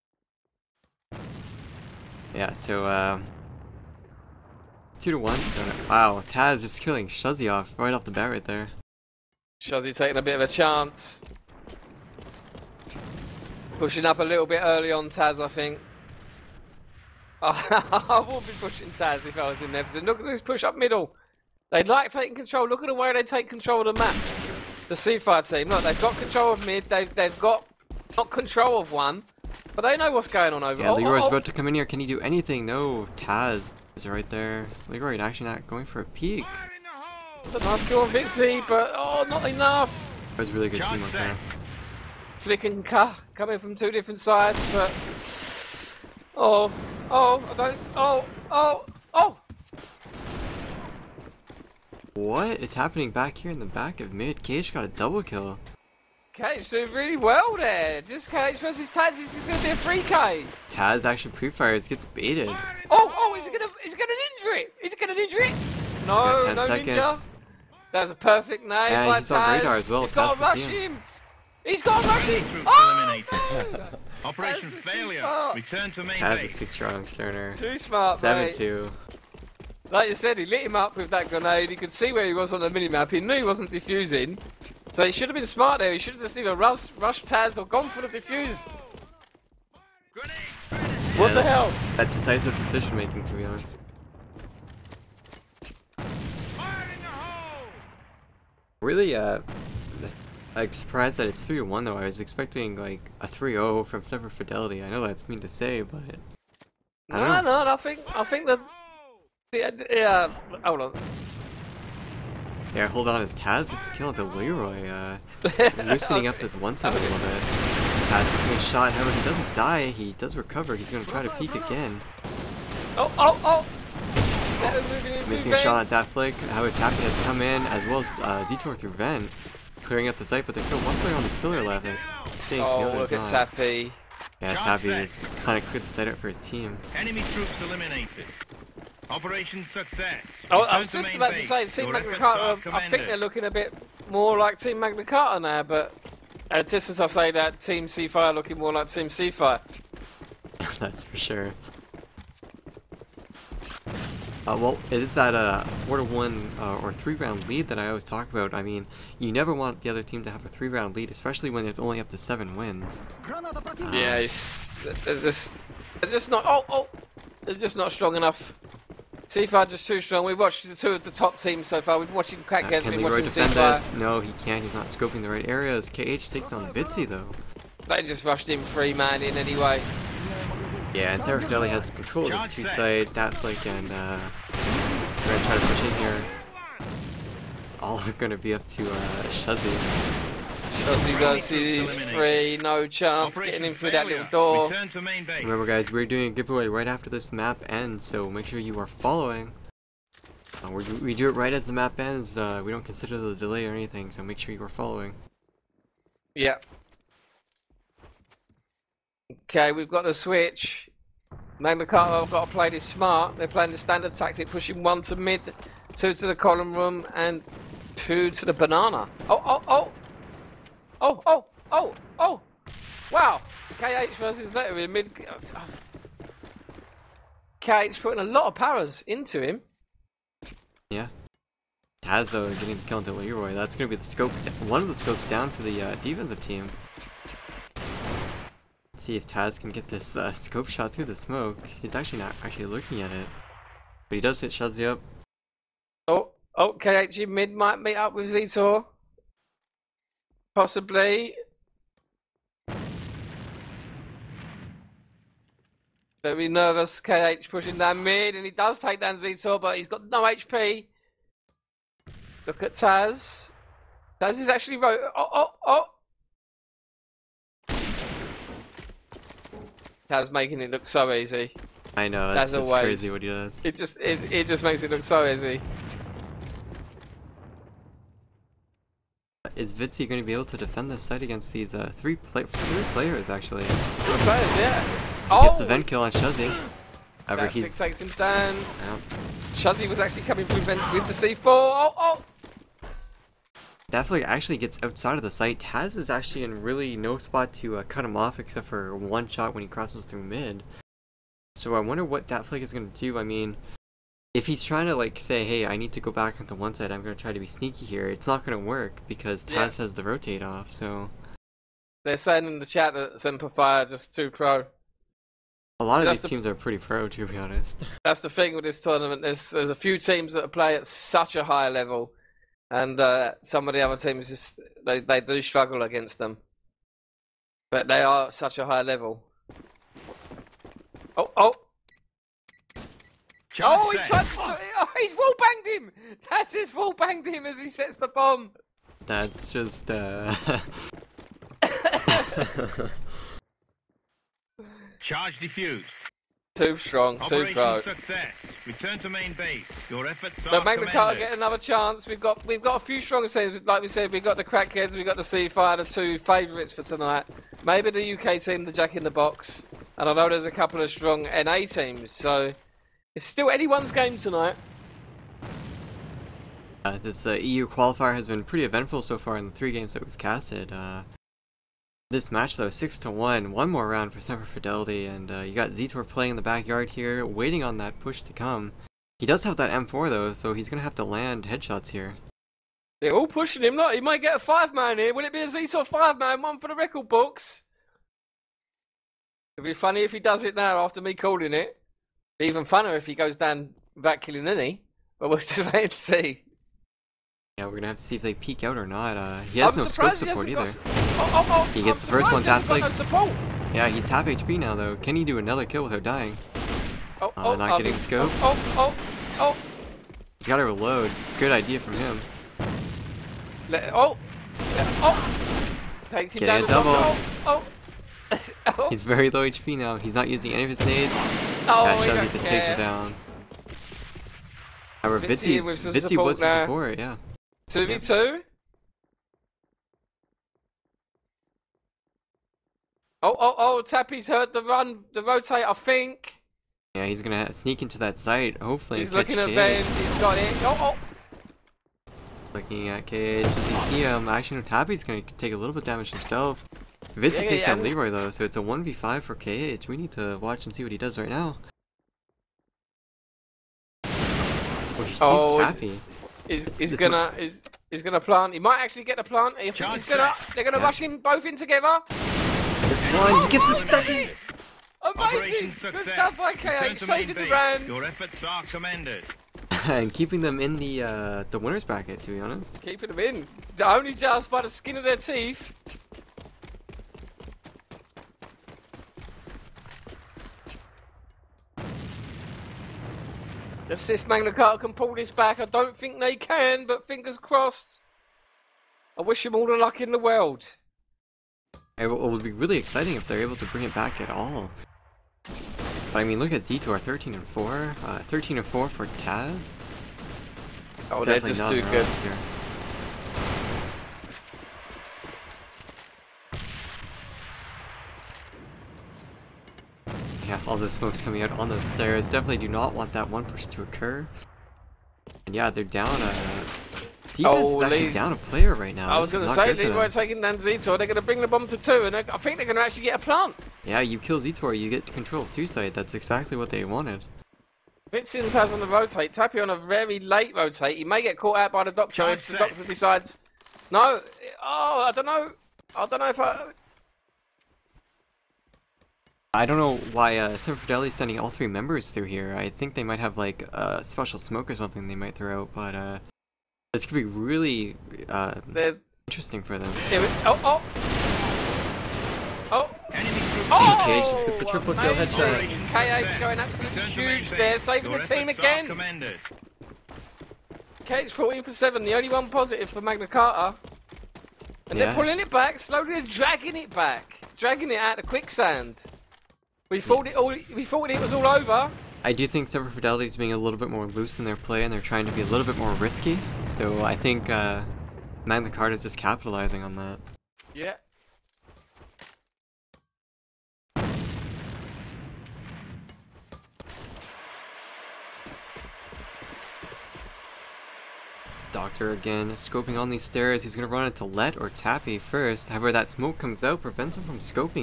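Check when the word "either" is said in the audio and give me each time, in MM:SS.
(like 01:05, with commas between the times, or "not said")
01:26, 06:40.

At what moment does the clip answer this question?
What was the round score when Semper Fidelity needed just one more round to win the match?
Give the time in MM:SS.
06:12.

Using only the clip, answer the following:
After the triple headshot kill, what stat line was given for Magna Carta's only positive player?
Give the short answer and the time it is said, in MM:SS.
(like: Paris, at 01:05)
14 for 7, at 09:21.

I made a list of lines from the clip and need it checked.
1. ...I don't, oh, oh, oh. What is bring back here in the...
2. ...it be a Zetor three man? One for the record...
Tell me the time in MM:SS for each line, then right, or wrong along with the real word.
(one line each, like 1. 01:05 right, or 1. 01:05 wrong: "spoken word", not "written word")
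1. 00:47 wrong: "happening", not "bring"
2. 06:25 wrong: "five", not "three".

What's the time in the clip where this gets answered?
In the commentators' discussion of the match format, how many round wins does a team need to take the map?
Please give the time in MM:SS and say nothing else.
02:41.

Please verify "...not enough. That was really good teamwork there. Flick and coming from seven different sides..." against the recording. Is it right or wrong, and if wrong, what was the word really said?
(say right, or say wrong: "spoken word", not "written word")
wrong: "two", not "seven".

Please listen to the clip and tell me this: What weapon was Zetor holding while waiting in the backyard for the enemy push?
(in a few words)
M4.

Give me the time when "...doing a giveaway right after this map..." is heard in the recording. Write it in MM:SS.
03:16.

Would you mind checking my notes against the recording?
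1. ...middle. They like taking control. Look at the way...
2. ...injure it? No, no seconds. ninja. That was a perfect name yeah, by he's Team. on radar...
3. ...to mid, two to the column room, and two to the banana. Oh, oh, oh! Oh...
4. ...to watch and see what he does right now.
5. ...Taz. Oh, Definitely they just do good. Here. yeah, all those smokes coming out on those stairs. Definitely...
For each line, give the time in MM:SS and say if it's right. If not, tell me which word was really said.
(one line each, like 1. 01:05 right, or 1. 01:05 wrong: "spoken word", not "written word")
1. 00:20 right
2. 01:05 wrong: "Taz", not "Team"
3. 03:35 right
4. 07:30 right
5. 08:19 right.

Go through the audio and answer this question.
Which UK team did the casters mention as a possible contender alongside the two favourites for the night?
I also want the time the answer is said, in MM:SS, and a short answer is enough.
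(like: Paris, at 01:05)
Jack in the Box, at 05:58.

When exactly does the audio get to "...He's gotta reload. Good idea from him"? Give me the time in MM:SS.
06:50.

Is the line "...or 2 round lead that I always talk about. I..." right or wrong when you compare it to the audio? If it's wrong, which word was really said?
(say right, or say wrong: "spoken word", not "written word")
wrong: "3", not "2".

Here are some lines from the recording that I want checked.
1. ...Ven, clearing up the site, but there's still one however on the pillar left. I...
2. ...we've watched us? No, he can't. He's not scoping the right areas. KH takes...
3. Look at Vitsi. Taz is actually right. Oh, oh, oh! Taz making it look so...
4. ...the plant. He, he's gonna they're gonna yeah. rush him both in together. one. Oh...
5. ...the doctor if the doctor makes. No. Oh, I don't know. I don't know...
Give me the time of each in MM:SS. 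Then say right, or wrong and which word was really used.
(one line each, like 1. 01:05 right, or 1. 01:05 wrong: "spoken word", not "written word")
1. 02:08 wrong: "player", not "however"
2. 02:52 right
3. 04:22 wrong: "Taz", not "Vitsi"
4. 07:39 right
5. 08:51 wrong: "decides", not "makes".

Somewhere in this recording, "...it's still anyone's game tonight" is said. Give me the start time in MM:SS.
06:03.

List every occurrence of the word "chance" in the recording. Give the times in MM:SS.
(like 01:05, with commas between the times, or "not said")
00:10, 03:12, 05:51.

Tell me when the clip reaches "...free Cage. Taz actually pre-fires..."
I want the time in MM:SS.
00:59.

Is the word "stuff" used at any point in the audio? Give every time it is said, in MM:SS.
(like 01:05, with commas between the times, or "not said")
07:46.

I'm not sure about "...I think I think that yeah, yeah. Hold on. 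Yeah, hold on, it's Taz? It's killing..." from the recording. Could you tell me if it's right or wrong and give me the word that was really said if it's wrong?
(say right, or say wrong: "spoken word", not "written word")
right.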